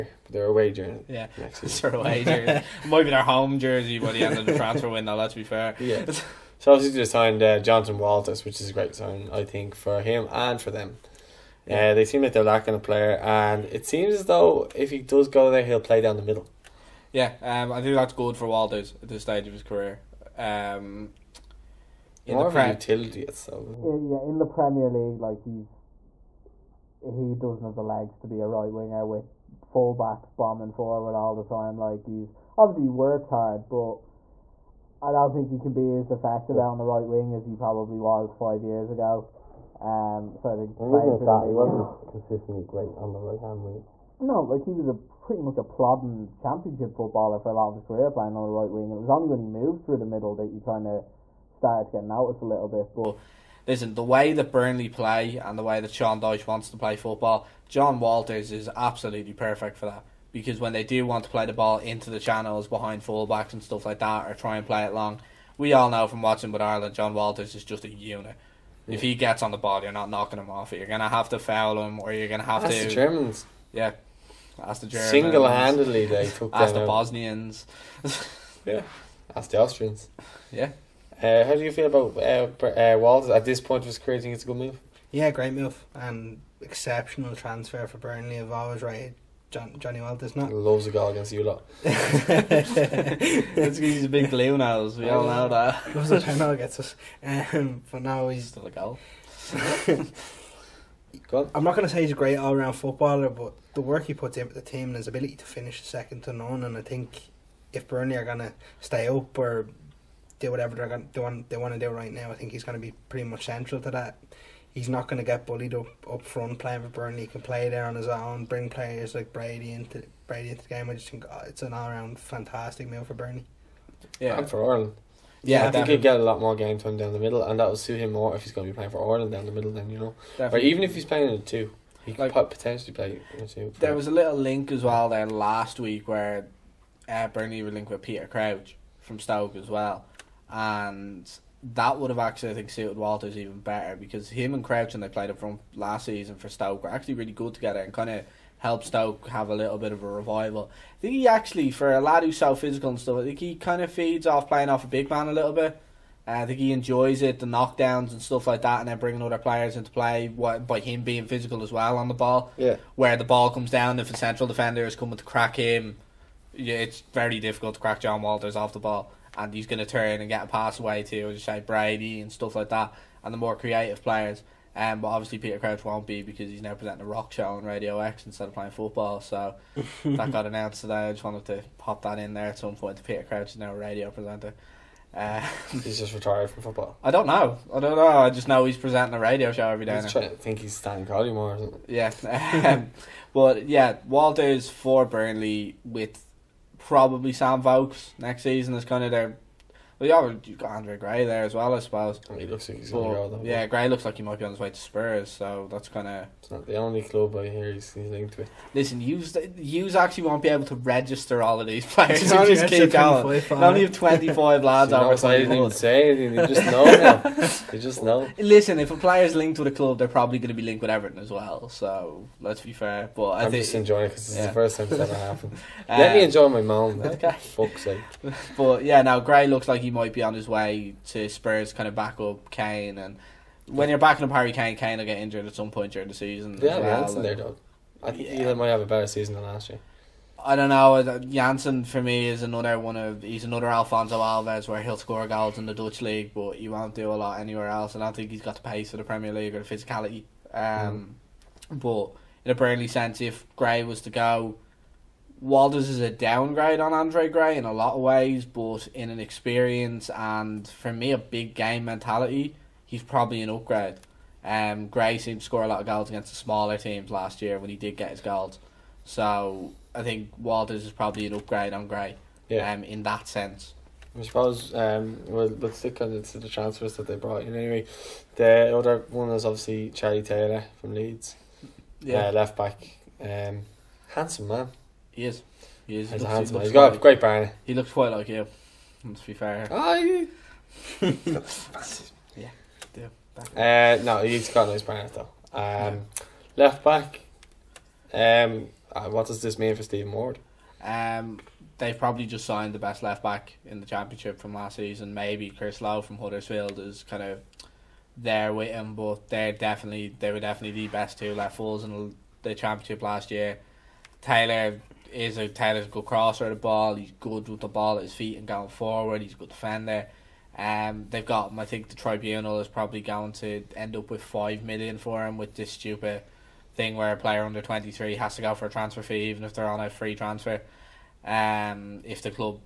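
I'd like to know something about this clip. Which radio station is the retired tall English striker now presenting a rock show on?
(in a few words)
Radio X.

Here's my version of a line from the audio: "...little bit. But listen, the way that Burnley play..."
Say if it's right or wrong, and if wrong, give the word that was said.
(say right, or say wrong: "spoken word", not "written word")
right.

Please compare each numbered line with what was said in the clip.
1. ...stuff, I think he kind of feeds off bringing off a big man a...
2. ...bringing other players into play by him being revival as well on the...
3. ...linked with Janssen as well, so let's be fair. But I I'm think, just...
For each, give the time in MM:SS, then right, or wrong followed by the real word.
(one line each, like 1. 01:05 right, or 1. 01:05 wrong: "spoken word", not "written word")
1. 02:32 wrong: "playing", not "bringing"
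2. 02:38 wrong: "physical", not "revival"
3. 03:40 wrong: "Everton", not "Janssen".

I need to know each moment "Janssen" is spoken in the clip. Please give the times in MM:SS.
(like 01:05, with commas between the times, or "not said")
03:57, 04:01.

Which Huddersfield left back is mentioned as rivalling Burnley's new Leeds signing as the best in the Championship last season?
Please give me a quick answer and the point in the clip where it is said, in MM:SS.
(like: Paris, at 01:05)
Chris Lowe, at 05:05.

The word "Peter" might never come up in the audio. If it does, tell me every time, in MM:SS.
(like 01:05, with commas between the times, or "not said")
02:18, 02:55, 03:03.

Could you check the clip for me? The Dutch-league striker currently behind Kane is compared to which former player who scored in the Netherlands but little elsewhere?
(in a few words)
Alfonso Alves.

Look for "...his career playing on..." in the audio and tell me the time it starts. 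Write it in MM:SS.
00:47.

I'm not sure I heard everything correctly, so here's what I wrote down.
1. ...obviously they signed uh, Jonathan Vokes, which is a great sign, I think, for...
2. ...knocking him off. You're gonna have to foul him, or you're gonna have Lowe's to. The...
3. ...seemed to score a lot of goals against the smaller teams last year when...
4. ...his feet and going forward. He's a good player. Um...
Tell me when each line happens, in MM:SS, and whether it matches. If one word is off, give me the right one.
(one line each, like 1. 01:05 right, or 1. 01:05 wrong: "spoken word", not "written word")
1. 00:06 wrong: "Walters", not "Vokes"
2. 01:10 wrong: "That", not "Lowe"
3. 04:25 right
4. 05:18 wrong: "defender", not "player".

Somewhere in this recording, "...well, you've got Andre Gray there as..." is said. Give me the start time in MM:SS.
03:19.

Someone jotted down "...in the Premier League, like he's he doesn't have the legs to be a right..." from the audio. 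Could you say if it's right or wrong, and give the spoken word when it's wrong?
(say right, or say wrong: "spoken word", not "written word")
right.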